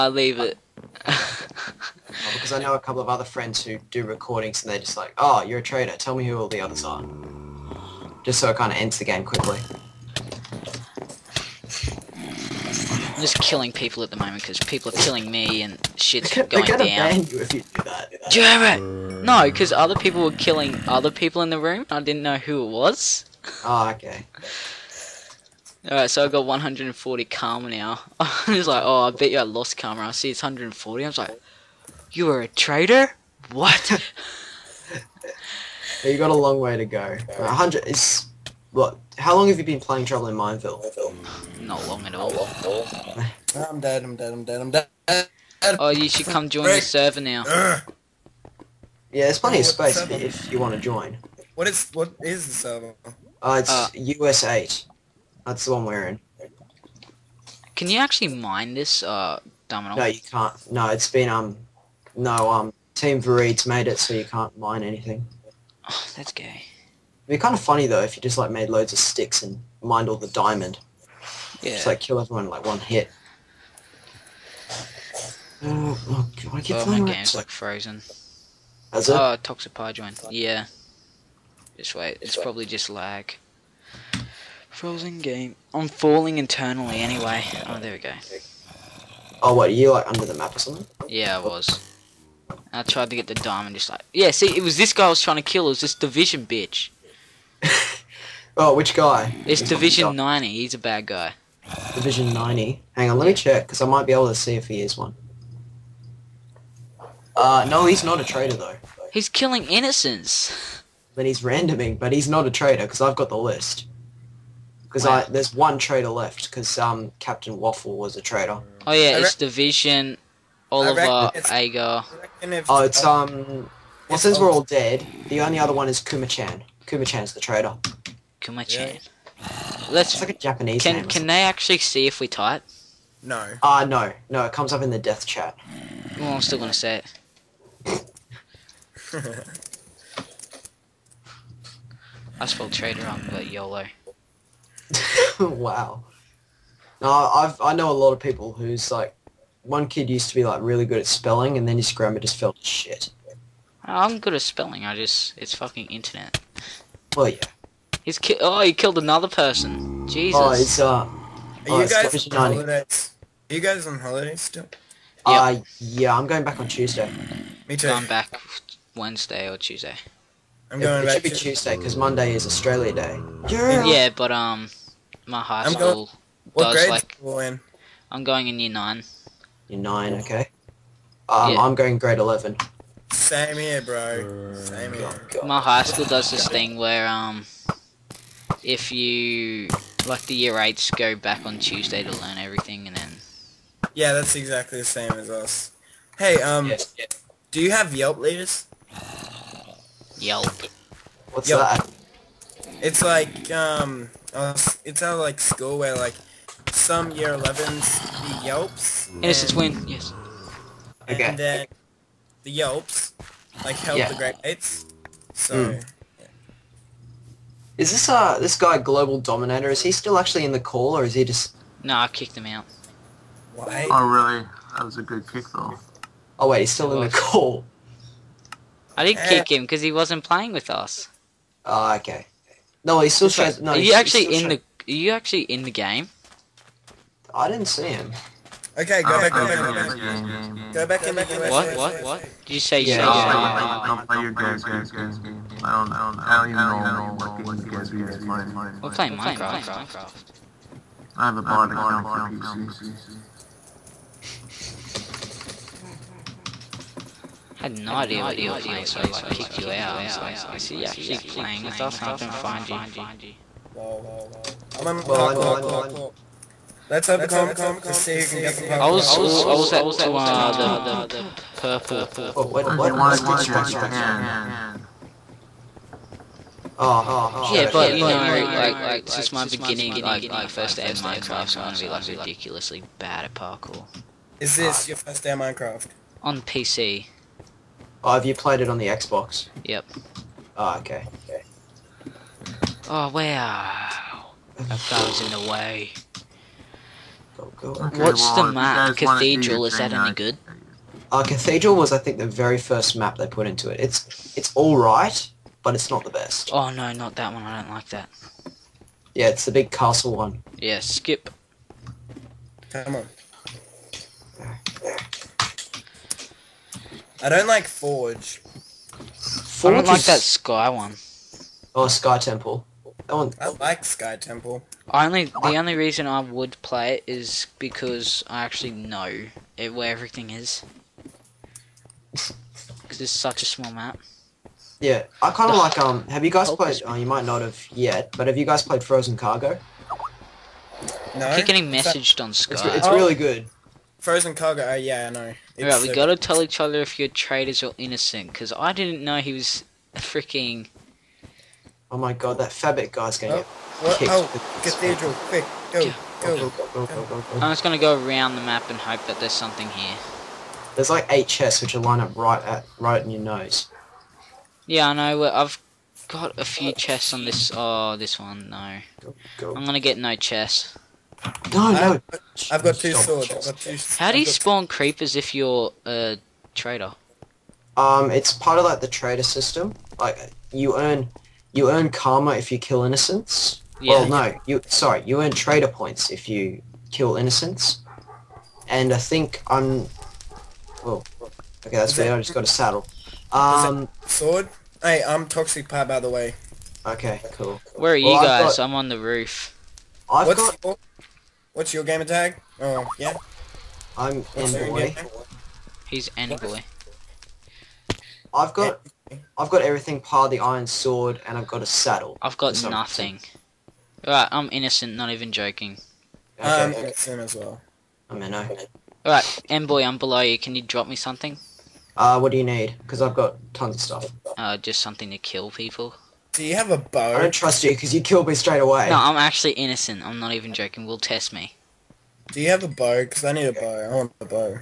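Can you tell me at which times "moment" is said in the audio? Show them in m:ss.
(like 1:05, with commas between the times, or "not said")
0:14.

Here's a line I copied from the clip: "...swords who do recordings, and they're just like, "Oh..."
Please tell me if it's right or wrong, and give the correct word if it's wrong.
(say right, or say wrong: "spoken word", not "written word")
wrong: "friends", not "swords".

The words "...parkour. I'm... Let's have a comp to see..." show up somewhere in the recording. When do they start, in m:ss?
4:25.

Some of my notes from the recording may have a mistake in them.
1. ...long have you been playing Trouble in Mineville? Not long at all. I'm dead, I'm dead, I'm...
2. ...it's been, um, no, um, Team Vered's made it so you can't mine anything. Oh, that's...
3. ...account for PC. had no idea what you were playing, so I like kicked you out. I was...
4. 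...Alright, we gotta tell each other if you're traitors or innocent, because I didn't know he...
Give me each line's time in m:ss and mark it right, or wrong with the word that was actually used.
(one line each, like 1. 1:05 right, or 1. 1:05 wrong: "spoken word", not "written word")
1. 0:39 right
2. 1:00 right
3. 4:11 right
4. 5:45 right.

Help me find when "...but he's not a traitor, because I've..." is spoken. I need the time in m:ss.
1:51.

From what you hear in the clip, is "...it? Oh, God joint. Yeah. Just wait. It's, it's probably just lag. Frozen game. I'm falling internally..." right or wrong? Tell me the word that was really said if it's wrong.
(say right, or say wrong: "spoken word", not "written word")
wrong: "Toxopar", not "God".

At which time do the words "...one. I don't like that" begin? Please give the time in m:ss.
5:07.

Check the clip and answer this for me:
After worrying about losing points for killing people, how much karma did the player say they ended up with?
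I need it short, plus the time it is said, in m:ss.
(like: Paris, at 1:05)
140, at 0:26.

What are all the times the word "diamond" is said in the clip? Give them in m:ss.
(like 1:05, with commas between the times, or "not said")
1:10, 1:33.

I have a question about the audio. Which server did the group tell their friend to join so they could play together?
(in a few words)
US8.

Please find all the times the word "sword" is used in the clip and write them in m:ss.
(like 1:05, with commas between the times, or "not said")
6:12, 6:34, 6:50.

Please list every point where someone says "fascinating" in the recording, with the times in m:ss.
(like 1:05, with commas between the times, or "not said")
not said.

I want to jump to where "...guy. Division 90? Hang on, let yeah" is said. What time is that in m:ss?
1:41.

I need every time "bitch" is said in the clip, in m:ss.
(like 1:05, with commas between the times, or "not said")
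1:36.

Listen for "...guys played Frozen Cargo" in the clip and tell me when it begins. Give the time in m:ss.
5:38.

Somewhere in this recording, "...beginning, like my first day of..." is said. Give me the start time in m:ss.
4:39.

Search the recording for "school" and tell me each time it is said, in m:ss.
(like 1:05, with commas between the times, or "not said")
2:55, 3:05, 3:25.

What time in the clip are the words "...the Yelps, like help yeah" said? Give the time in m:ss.
3:32.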